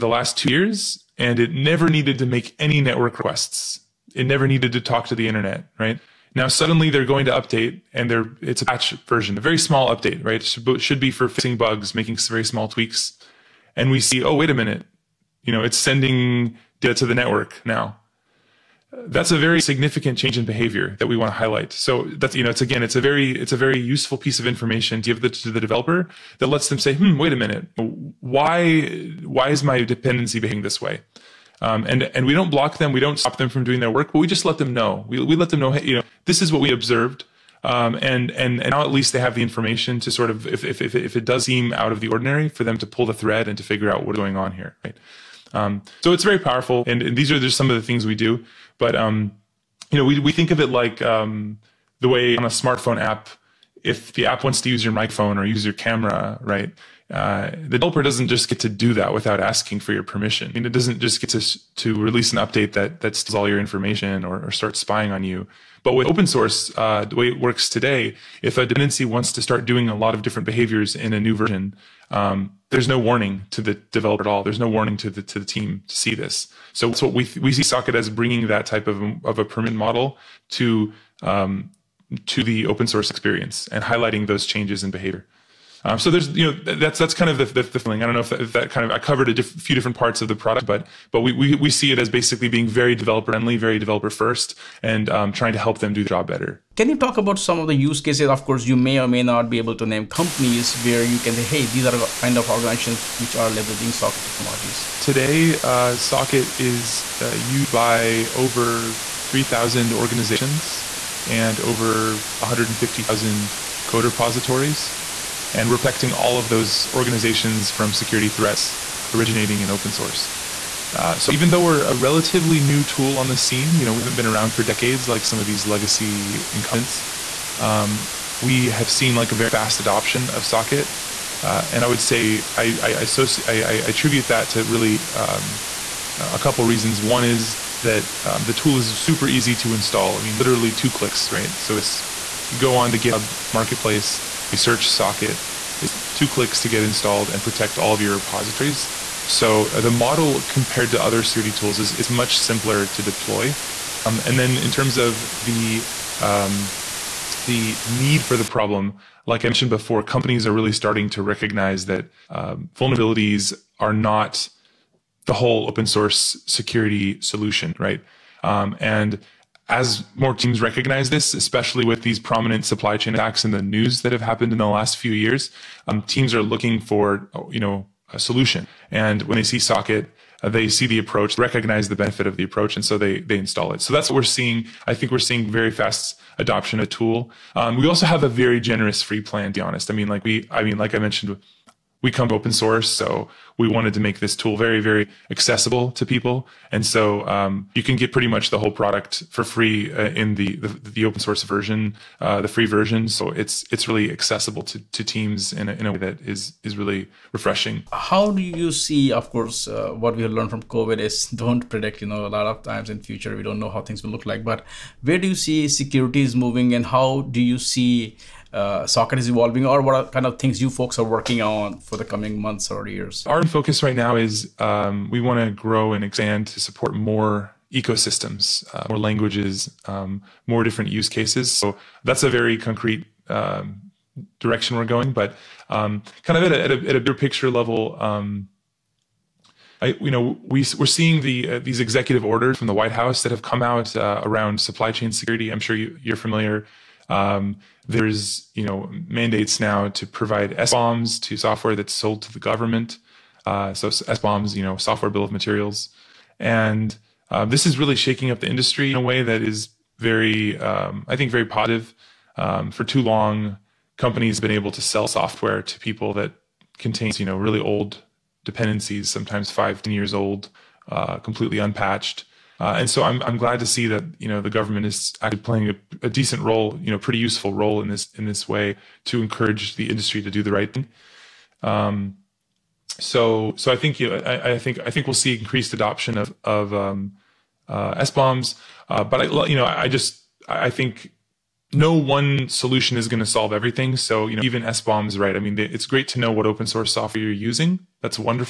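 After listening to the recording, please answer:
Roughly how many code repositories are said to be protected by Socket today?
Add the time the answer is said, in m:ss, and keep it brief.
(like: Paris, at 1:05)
over 150,000, at 1:51.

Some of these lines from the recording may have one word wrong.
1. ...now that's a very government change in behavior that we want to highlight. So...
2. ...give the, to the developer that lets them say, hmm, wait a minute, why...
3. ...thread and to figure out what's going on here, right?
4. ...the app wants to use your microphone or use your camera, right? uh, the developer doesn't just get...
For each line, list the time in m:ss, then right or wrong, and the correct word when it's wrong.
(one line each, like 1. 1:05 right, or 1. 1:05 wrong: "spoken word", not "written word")
1. 0:17 wrong: "significant", not "government"
2. 0:25 right
3. 0:43 right
4. 0:54 right.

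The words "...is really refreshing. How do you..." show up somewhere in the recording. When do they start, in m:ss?
3:26.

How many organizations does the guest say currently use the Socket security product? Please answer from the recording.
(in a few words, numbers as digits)
over 3,000.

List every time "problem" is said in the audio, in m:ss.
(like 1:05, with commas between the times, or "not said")
2:38.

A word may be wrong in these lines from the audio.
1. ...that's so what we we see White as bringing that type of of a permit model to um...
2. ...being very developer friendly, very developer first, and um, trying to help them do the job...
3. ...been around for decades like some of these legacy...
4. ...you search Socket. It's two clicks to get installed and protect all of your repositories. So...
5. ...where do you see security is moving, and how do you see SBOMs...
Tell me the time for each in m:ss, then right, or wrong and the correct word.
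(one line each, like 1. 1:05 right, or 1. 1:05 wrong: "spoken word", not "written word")
1. 1:16 wrong: "Socket", not "White"
2. 1:32 right
3. 2:04 right
4. 2:24 right
5. 3:35 wrong: "Socket", not "SBOMs".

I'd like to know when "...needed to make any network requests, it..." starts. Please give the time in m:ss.
0:01.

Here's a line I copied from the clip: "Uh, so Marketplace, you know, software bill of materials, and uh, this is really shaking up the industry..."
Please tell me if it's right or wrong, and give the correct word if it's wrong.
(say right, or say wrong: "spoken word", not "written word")
wrong: "SBOMs", not "Marketplace".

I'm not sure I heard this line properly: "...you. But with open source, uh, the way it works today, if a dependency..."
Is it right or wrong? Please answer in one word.
right.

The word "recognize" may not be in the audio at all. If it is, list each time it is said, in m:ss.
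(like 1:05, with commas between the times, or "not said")
2:41, 2:50, 3:01.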